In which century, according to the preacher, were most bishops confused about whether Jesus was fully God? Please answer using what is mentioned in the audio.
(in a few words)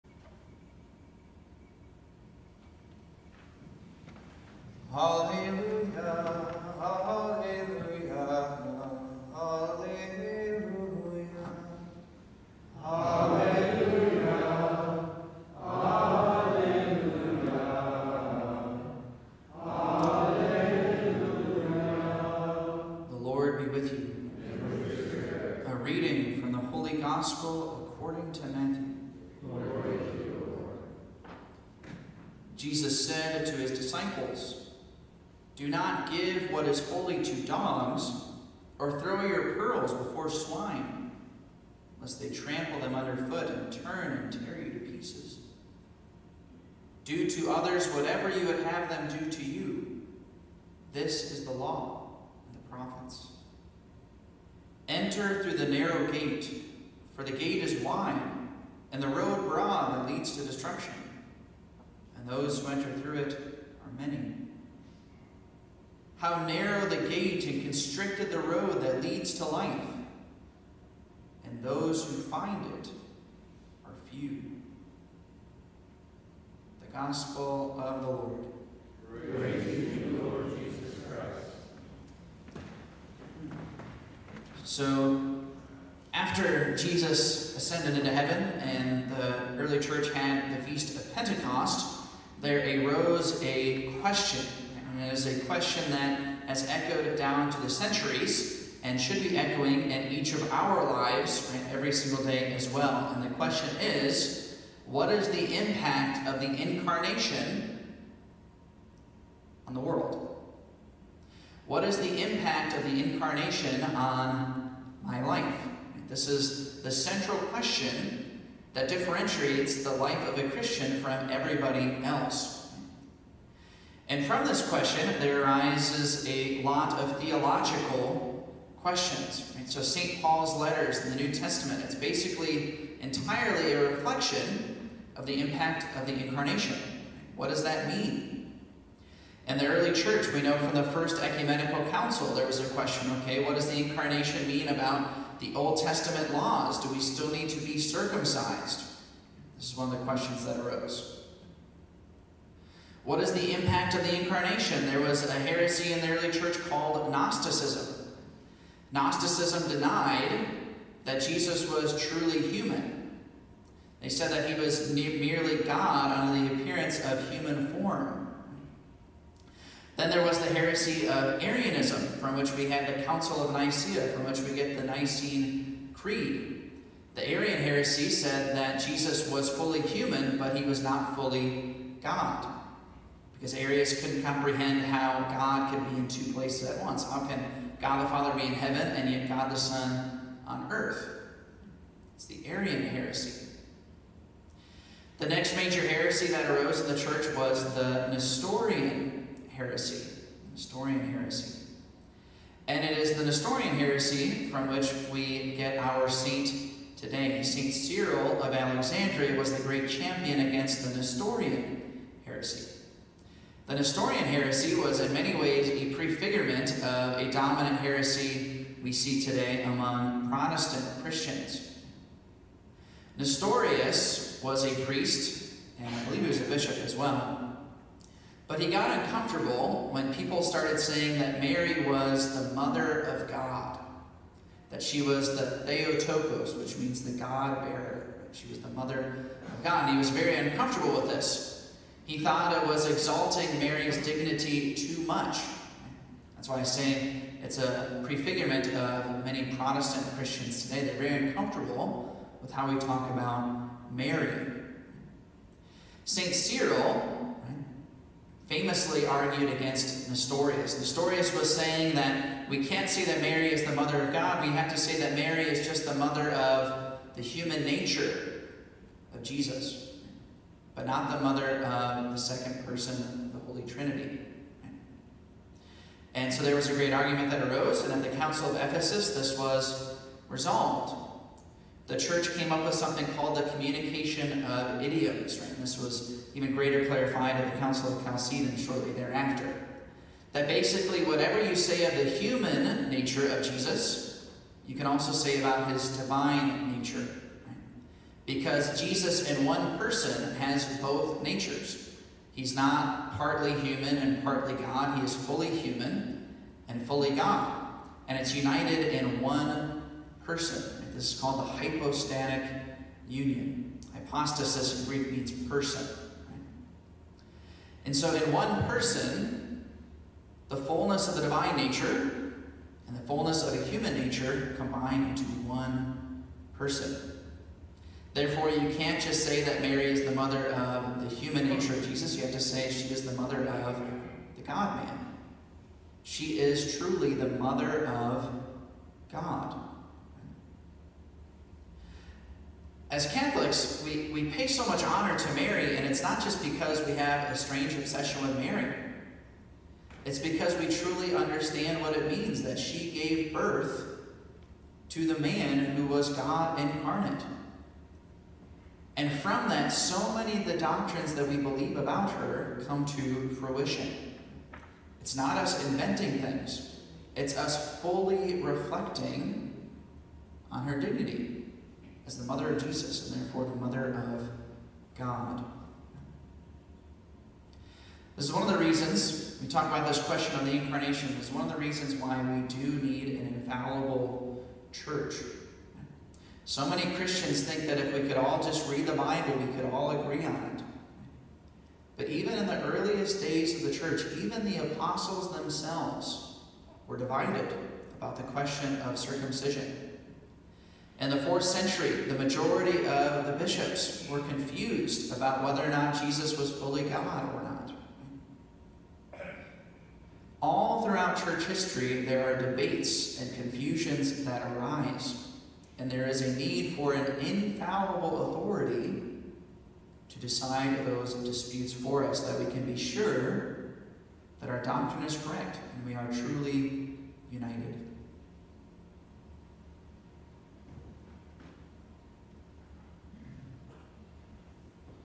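4th century.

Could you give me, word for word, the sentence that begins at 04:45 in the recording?
And this was even greater clarified at the Council of Chalcedon shortly thereafter.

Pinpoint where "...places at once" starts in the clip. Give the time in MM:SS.
03:06.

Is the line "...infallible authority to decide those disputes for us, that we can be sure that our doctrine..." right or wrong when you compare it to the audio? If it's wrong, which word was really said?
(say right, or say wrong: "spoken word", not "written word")
right.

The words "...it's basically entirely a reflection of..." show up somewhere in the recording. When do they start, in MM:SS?
02:11.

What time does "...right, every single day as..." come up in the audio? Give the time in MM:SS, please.
01:41.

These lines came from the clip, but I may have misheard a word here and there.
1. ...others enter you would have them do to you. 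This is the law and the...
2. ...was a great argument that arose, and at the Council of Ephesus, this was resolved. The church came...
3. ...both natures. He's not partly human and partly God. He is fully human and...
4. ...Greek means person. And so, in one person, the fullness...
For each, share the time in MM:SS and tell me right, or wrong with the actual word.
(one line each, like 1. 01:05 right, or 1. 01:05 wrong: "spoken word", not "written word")
1. 00:47 wrong: "whatever", not "enter"
2. 04:36 right
3. 05:00 right
4. 05:14 right.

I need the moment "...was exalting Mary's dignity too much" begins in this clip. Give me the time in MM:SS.
04:02.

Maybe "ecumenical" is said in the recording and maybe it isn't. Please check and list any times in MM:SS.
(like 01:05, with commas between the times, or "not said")
02:21.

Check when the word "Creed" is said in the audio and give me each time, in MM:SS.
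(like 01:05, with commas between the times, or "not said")
02:55.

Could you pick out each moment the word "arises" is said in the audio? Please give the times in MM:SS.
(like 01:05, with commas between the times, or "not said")
02:05, 06:54.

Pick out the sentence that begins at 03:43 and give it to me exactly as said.
Nestorius was a priest, and I believe he was a bishop as well.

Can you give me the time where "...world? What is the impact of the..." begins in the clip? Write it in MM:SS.
01:49.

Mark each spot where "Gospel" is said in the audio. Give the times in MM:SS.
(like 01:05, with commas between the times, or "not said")
00:26, 01:16.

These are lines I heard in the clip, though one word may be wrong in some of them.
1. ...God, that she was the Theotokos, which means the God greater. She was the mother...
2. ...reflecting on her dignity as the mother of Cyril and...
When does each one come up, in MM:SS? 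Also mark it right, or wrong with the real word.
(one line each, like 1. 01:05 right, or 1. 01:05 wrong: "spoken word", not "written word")
1. 03:53 wrong: "bearer", not "greater"
2. 06:08 wrong: "Jesus", not "Cyril".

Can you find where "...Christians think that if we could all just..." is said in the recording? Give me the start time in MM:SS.
06:26.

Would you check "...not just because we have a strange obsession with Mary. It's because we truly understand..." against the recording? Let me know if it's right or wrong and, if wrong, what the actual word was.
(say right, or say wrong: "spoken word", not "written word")
right.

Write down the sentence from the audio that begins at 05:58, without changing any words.
And from that, so many of the doctrines that we believe about her come to fruition.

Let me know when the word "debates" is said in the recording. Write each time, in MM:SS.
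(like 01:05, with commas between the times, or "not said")
06:52.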